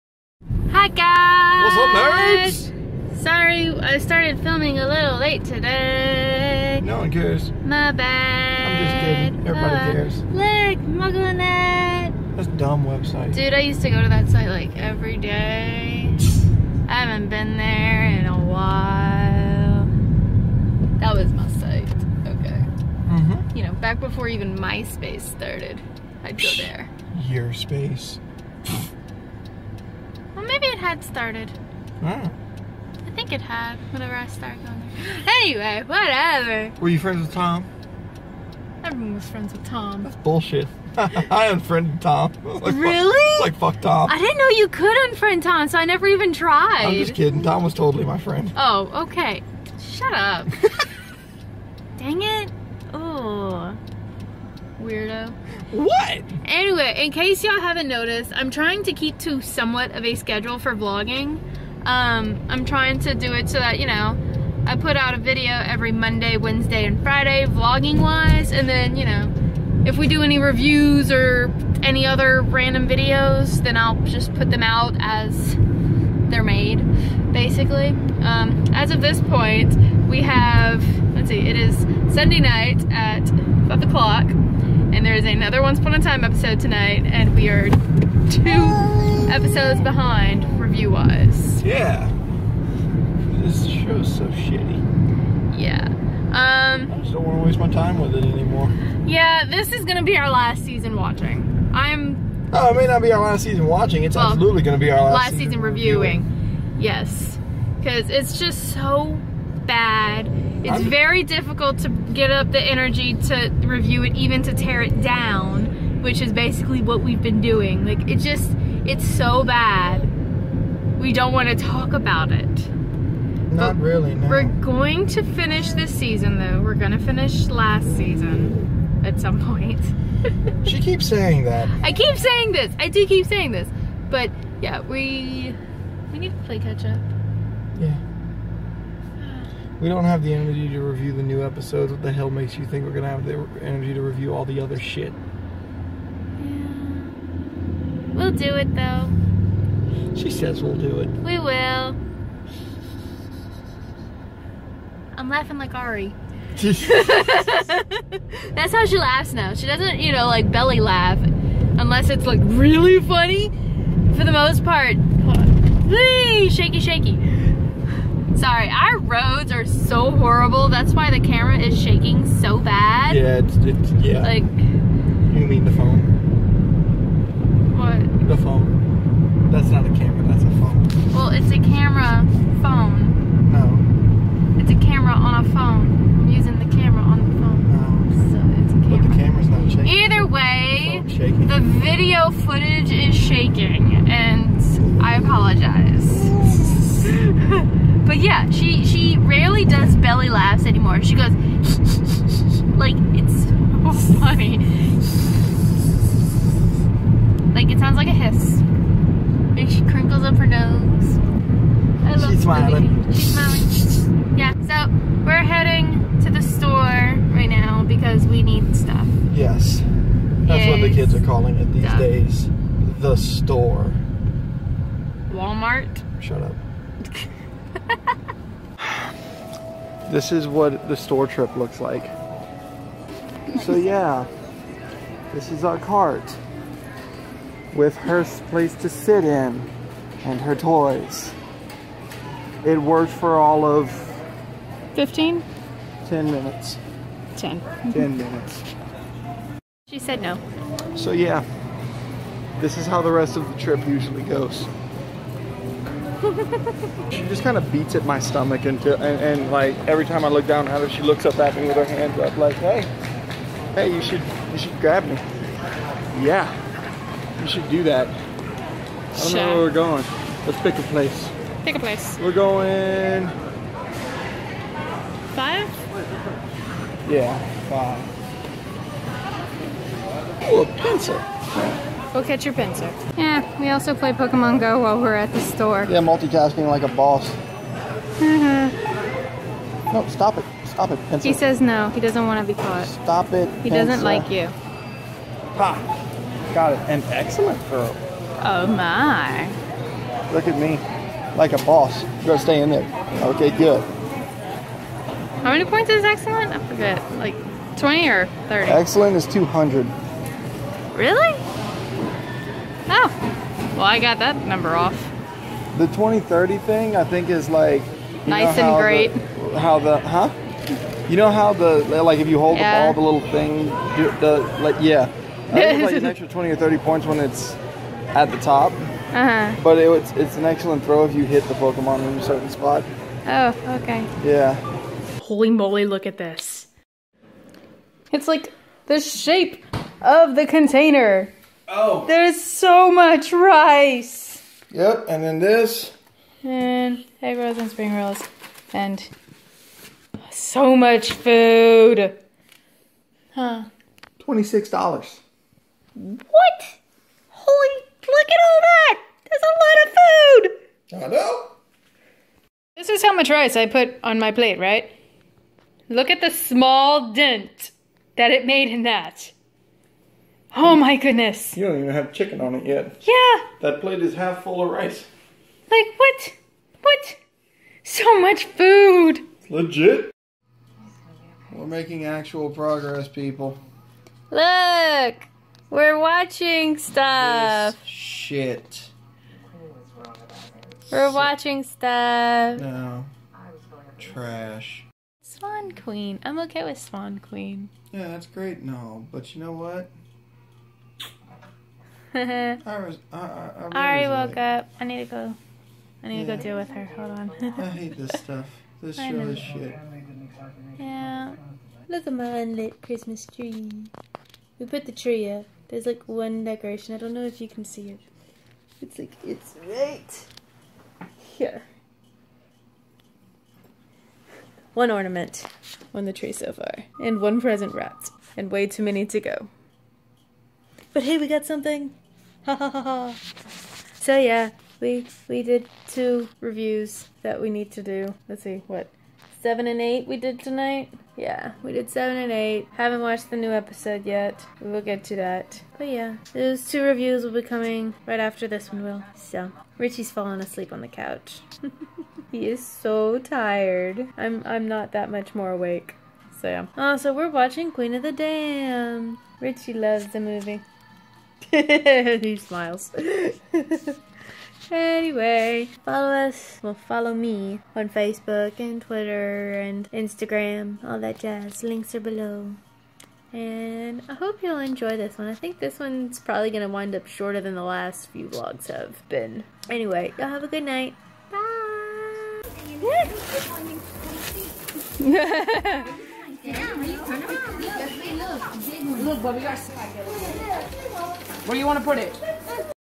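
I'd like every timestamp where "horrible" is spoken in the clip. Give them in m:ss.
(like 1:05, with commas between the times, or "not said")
2:50.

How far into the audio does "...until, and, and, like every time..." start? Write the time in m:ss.
4:18.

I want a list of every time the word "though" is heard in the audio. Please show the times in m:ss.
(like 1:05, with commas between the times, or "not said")
2:06, 2:28.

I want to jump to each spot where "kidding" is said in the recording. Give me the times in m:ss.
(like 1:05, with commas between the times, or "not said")
0:09, 0:47.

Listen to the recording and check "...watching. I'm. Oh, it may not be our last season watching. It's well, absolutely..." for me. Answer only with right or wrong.
right.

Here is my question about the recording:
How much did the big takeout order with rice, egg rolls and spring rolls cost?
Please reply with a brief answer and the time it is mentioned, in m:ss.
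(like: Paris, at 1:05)
$26, at 5:54.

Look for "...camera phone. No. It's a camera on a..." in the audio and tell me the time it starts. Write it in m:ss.
3:01.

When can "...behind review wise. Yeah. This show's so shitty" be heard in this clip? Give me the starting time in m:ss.
1:29.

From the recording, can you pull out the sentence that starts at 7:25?
But yeah, those two reviews will be coming right after this one will.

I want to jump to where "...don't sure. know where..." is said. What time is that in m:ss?
4:29.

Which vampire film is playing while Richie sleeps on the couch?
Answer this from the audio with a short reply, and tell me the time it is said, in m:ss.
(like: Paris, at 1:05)
Queen of the Damned, at 7:37.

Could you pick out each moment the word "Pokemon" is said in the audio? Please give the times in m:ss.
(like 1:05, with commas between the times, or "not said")
4:44, 5:31.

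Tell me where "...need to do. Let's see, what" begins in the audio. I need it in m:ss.
7:17.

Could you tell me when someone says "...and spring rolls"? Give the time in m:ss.
5:47.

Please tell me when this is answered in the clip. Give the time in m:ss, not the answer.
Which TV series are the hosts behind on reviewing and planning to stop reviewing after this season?
1:25.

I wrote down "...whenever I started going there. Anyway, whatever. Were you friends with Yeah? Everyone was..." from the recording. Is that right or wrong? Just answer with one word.
wrong.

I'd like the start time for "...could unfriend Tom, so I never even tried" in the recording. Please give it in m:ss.
0:44.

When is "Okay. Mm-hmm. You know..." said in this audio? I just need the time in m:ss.
0:21.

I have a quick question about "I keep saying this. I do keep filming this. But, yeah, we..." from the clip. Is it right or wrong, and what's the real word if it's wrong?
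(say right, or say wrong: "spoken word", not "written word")
wrong: "saying", not "filming".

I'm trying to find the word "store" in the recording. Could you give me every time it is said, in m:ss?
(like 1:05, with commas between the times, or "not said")
3:43, 3:50, 4:45.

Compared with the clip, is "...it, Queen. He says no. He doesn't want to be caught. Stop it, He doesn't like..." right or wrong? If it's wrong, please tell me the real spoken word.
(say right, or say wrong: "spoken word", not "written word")
wrong: "Pinsir", not "Queen".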